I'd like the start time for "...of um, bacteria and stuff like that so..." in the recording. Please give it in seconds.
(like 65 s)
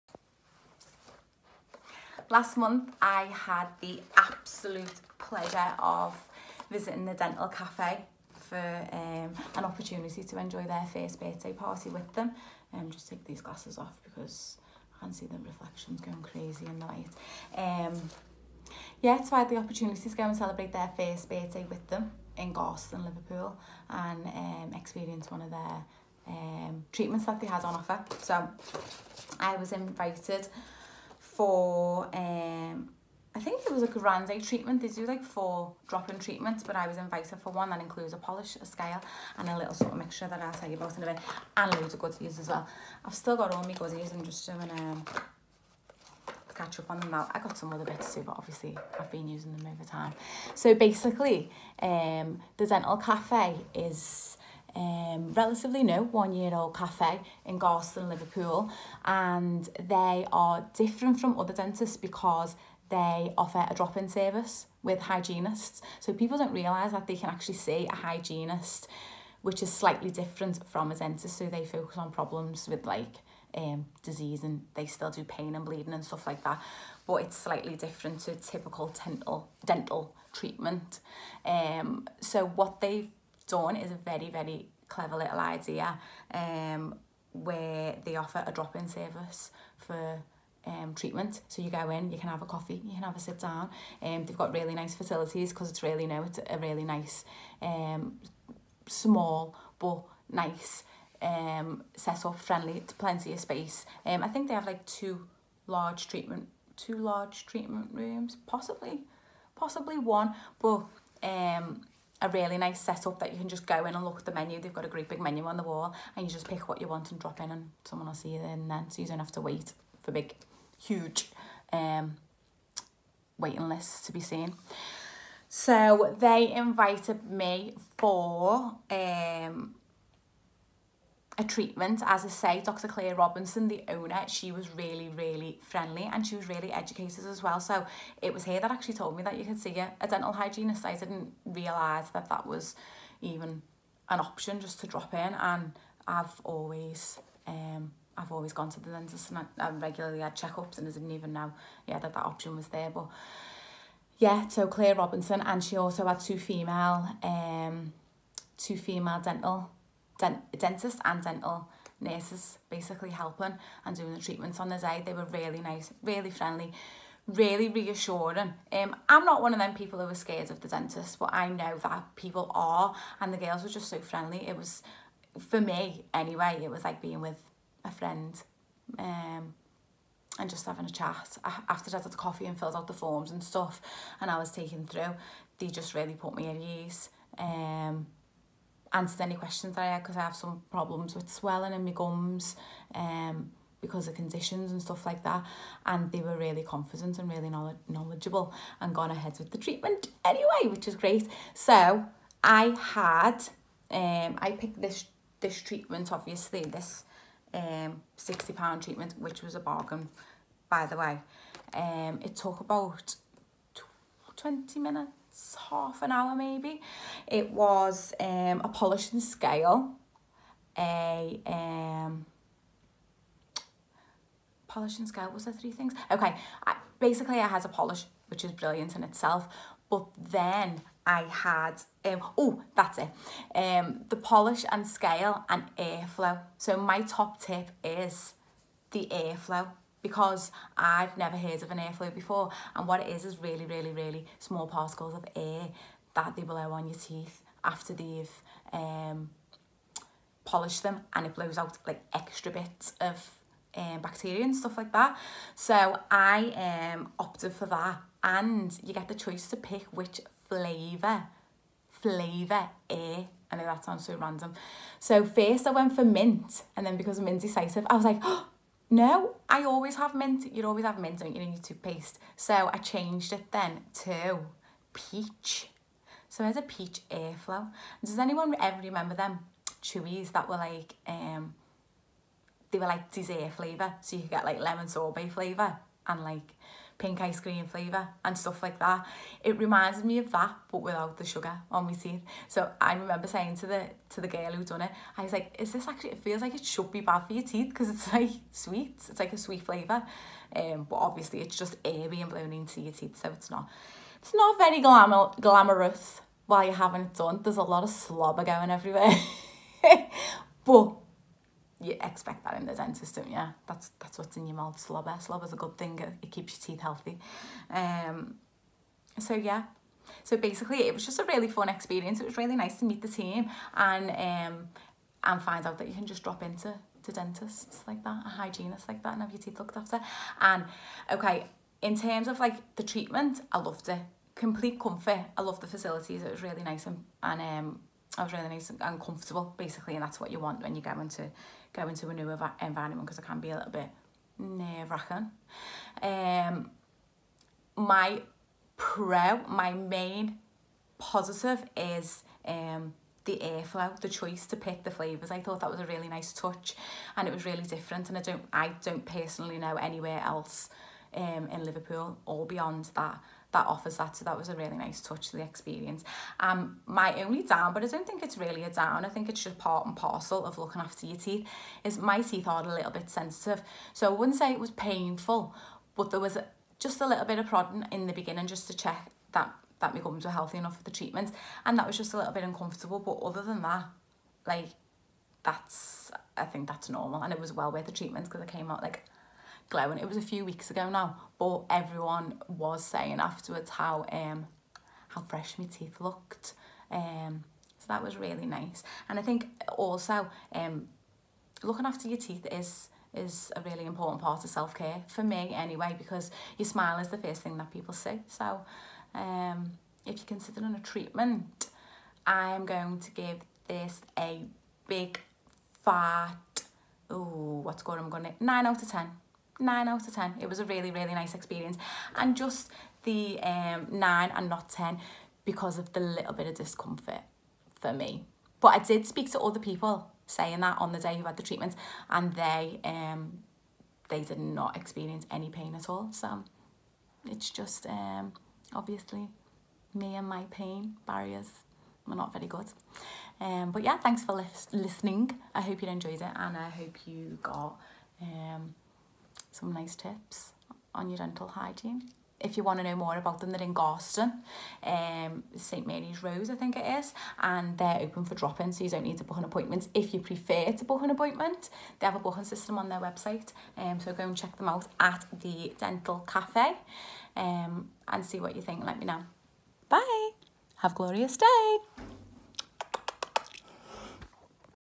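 253 s.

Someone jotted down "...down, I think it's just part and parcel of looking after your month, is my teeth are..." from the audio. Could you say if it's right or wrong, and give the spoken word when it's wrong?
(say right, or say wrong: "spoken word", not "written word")
wrong: "teeth", not "month".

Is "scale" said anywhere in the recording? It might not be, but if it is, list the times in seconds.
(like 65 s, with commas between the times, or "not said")
38 s, 219 s, 225 s, 234 s.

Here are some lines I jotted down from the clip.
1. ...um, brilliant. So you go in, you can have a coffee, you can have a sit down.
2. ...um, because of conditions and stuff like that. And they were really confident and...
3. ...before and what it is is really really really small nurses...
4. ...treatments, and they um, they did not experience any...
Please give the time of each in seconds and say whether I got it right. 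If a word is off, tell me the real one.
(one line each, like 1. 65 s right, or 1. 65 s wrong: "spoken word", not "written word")
1. 90 s wrong: "treatment", not "brilliant"
2. 192 s right
3. 242 s wrong: "particles", not "nurses"
4. 431 s right.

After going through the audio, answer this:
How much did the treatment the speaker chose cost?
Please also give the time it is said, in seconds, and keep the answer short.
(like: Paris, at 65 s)
£60, at 208 s.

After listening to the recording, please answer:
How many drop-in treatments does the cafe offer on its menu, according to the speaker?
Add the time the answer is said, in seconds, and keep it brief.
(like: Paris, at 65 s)
4, at 35 s.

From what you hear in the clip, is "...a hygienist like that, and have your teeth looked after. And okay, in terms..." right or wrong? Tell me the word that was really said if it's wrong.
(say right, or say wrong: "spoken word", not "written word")
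right.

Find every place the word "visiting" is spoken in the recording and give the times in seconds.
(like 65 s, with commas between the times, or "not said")
6 s.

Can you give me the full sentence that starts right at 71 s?
So they focus on problems with like um, disease and they still do pain and bleeding and stuff like that.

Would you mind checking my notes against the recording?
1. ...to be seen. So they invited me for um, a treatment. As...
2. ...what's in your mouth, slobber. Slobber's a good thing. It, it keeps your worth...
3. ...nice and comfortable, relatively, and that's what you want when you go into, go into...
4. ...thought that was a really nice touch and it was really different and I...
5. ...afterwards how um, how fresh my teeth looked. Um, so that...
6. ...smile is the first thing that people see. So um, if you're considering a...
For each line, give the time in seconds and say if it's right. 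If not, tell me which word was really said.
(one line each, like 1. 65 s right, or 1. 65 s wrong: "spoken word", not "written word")
1. 124 s right
2. 314 s wrong: "teeth", not "worth"
3. 338 s wrong: "basically", not "relatively"
4. 355 s right
5. 393 s right
6. 406 s right.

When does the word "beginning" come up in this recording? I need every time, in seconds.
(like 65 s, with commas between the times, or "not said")
378 s.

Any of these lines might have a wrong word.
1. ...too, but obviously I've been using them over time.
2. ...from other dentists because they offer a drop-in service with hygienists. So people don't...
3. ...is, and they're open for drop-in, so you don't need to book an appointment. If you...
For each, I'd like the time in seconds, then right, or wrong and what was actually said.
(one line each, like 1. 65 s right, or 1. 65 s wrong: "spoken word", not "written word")
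1. 48 s right
2. 61 s right
3. 456 s right.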